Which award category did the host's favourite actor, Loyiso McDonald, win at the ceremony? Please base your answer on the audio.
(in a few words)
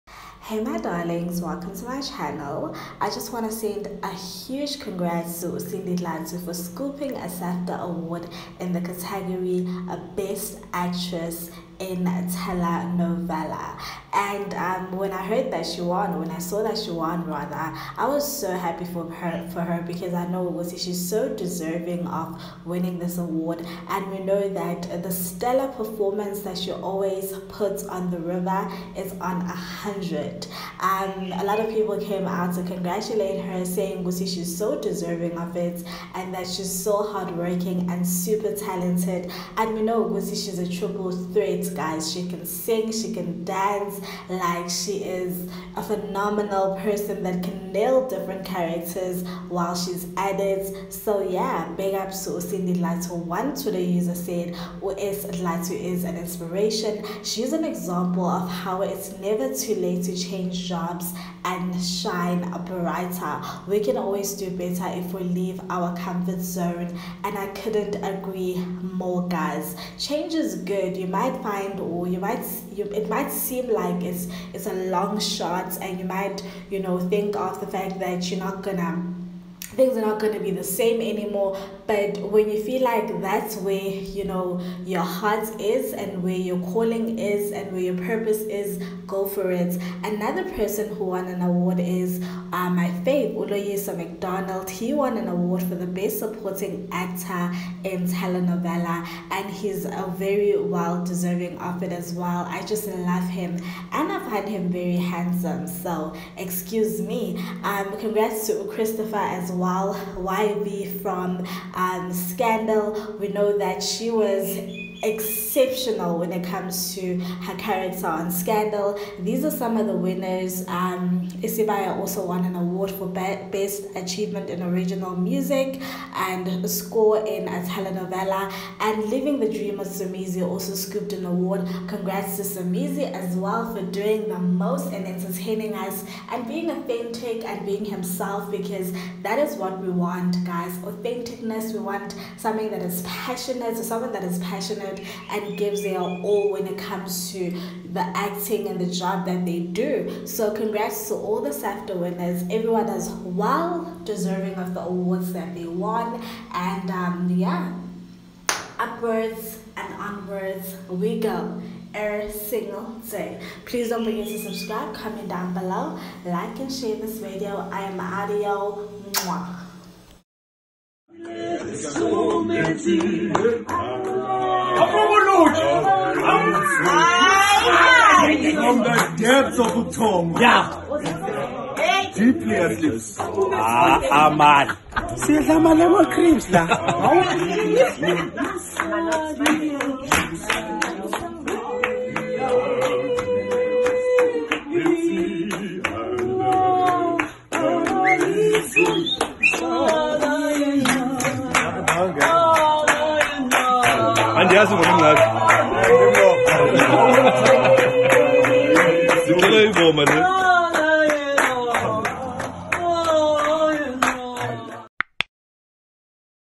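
Best supporting actor in telenovela.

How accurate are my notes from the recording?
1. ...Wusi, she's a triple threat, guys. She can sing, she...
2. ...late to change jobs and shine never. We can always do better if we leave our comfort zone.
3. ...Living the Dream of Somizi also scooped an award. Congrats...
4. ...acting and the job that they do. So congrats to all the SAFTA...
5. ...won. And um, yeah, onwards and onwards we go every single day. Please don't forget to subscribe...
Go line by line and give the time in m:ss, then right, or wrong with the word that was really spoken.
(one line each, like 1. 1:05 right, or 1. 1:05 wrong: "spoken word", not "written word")
1. 0:40 right
2. 0:59 wrong: "brighter", not "never"
3. 2:09 right
4. 2:28 right
5. 2:35 wrong: "upwards", not "onwards".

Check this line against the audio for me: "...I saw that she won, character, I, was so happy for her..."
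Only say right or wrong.
wrong.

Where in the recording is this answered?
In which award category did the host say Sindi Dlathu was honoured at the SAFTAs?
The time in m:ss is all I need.
0:10.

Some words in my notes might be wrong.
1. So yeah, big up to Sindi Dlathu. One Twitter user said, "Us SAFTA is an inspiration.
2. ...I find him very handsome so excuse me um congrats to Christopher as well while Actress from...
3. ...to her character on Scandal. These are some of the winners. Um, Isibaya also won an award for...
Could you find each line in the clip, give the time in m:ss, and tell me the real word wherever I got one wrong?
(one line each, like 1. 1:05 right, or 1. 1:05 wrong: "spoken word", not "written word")
1. 0:50 wrong: "Latu", not "SAFTA"
2. 1:44 wrong: "Wybe", not "Actress"
3. 1:56 right.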